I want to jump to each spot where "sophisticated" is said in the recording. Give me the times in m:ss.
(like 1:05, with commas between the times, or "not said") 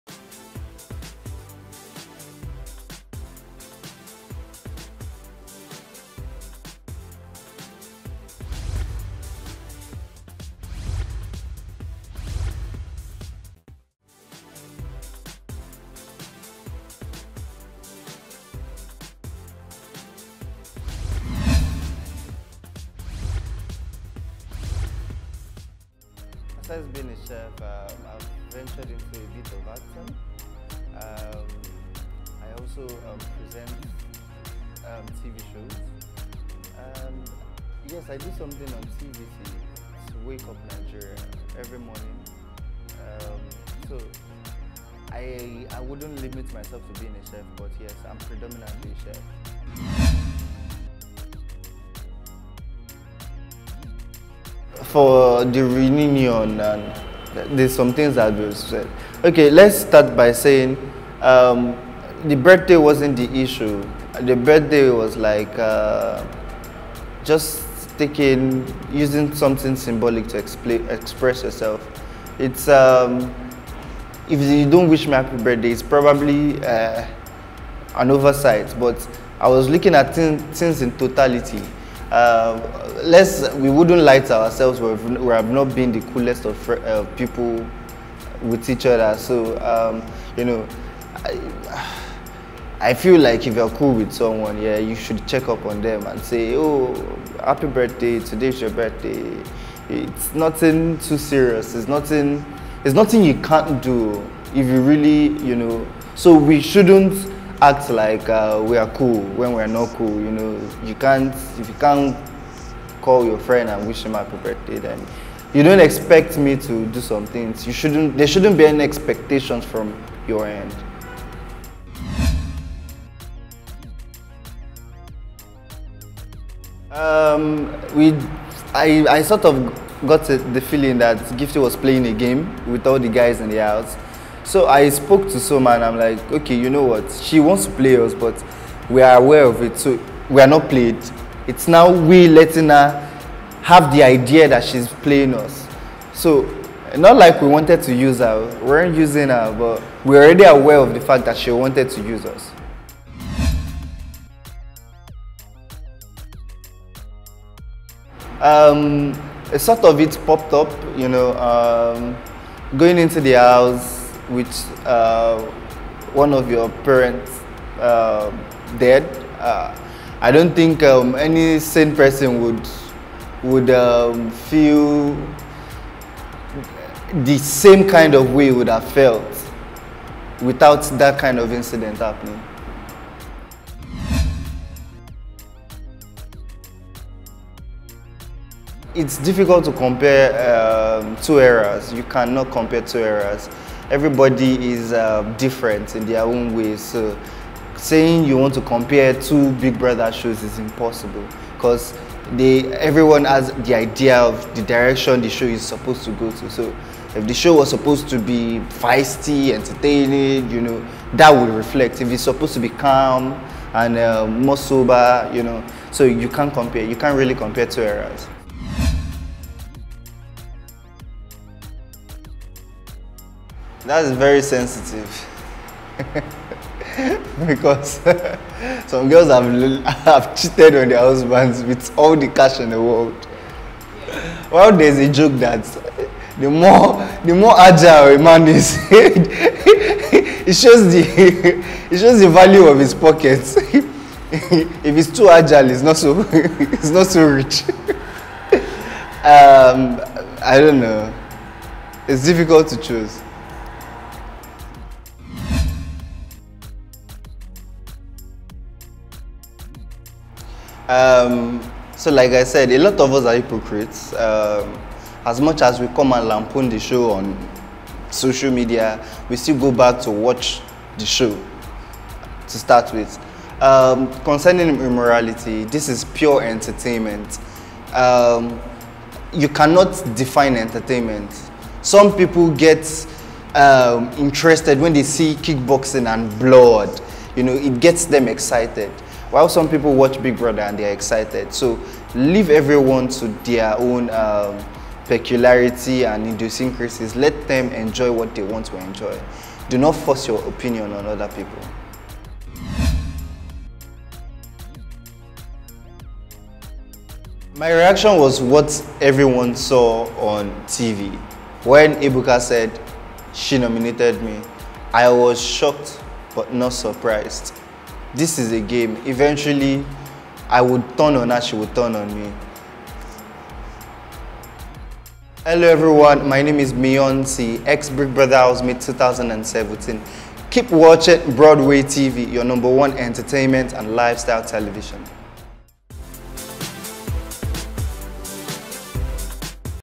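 not said.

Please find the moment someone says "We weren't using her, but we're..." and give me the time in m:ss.
2:28.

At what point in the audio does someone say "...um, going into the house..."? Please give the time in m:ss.
2:41.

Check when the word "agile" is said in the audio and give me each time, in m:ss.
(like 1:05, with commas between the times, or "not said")
3:57, 4:05.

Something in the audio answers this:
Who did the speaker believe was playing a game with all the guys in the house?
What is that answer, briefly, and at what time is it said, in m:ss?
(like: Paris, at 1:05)
Gifty, at 2:11.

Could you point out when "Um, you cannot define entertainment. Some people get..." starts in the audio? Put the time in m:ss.
4:37.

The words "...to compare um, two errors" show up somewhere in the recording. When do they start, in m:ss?
3:09.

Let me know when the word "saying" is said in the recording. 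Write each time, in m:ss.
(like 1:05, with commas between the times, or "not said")
1:00, 3:17.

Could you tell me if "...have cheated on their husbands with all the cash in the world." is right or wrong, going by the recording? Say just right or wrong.
right.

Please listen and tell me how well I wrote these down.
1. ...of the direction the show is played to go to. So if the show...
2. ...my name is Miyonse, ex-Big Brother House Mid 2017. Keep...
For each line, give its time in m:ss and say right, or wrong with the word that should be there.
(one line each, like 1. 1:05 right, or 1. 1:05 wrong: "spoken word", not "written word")
1. 3:24 wrong: "supposed", not "played"
2. 5:26 right.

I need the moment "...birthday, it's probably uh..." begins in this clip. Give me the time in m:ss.
1:15.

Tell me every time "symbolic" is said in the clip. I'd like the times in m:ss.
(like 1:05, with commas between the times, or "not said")
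1:09.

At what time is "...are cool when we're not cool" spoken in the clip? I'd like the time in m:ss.
1:48.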